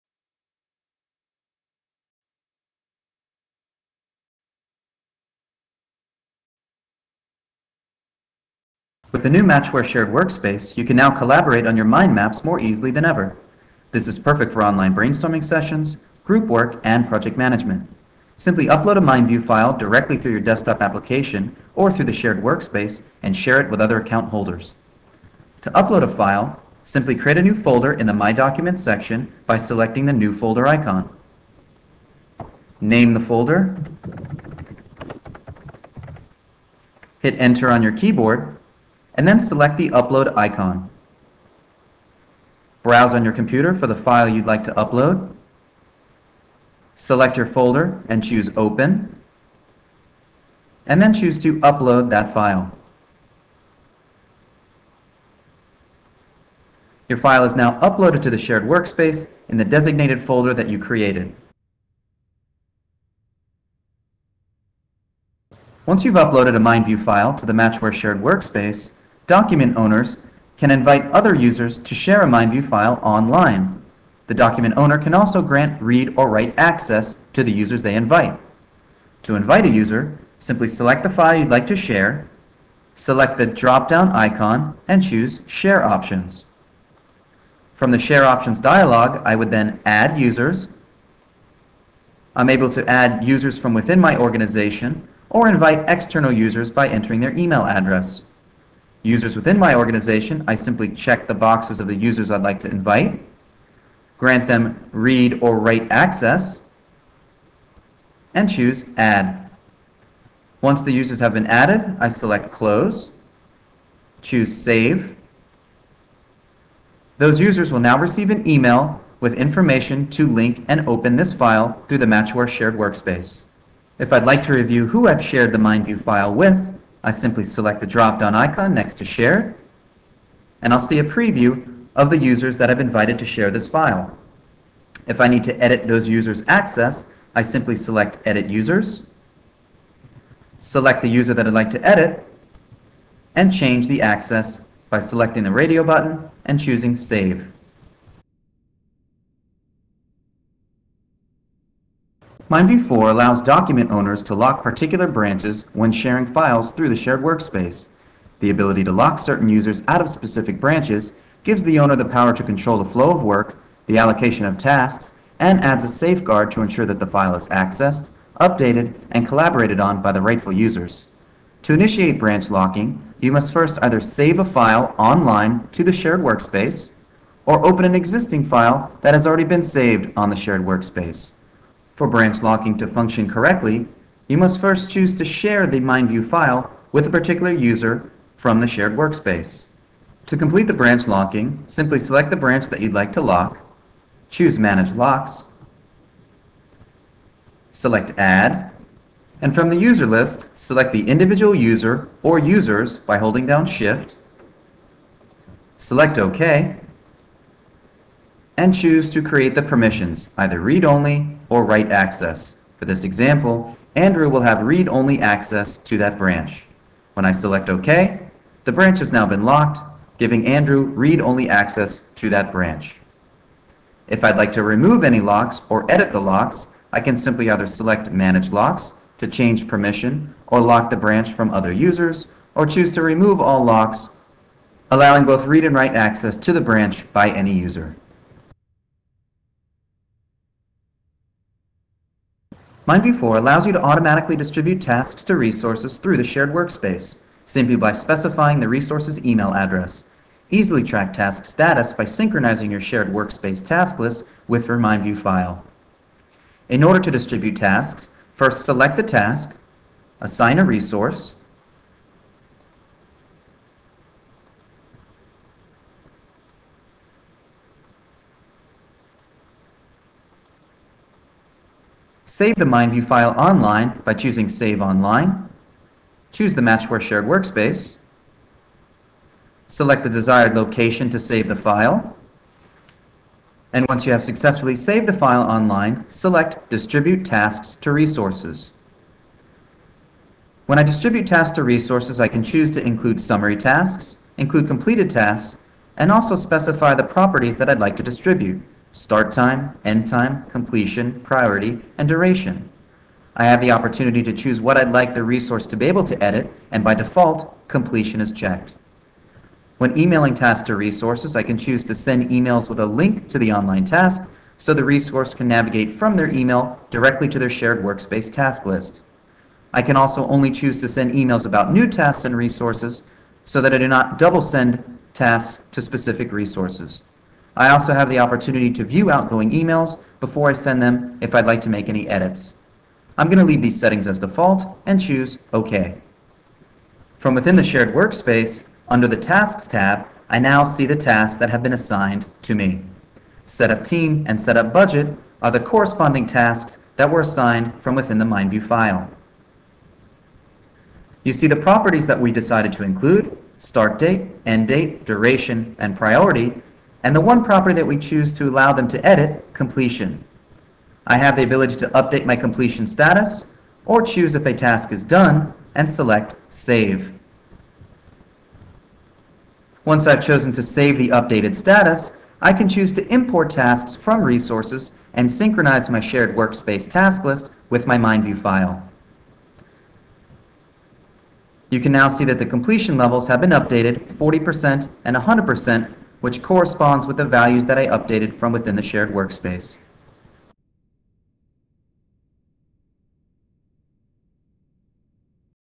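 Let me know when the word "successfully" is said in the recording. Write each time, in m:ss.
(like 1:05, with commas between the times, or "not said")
4:44.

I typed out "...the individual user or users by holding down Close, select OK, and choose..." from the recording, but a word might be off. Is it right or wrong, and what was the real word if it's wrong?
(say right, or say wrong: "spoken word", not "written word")
wrong: "Shift", not "Close".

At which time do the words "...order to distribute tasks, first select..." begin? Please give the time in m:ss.
4:16.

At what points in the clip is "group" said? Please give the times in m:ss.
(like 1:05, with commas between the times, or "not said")
0:16.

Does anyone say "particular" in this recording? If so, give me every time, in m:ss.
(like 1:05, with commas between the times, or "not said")
2:34, 3:07.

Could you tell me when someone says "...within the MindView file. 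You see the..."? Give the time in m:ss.
5:47.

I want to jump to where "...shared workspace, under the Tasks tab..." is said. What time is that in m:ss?
5:37.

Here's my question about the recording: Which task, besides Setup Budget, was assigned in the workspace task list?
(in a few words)
Setup Team.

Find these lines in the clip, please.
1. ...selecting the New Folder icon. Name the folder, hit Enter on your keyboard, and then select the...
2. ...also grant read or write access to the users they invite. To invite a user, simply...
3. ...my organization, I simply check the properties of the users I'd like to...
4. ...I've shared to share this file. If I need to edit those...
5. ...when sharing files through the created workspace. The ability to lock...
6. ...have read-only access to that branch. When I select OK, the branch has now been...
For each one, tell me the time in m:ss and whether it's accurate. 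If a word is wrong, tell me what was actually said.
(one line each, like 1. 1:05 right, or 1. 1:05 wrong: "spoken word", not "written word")
1. 0:29 right
2. 1:15 right
3. 1:39 wrong: "boxes", not "properties"
4. 2:12 wrong: "invited", not "shared"
5. 2:35 wrong: "shared", not "created"
6. 3:34 right.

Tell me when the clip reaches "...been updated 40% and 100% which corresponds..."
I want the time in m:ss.
6:23.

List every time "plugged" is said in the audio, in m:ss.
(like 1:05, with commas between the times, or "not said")
not said.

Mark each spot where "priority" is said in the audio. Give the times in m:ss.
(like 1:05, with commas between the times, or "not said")
5:01, 5:55.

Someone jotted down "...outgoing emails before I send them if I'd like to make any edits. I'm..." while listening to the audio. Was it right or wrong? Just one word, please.
right.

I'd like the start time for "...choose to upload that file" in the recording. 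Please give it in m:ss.
0:51.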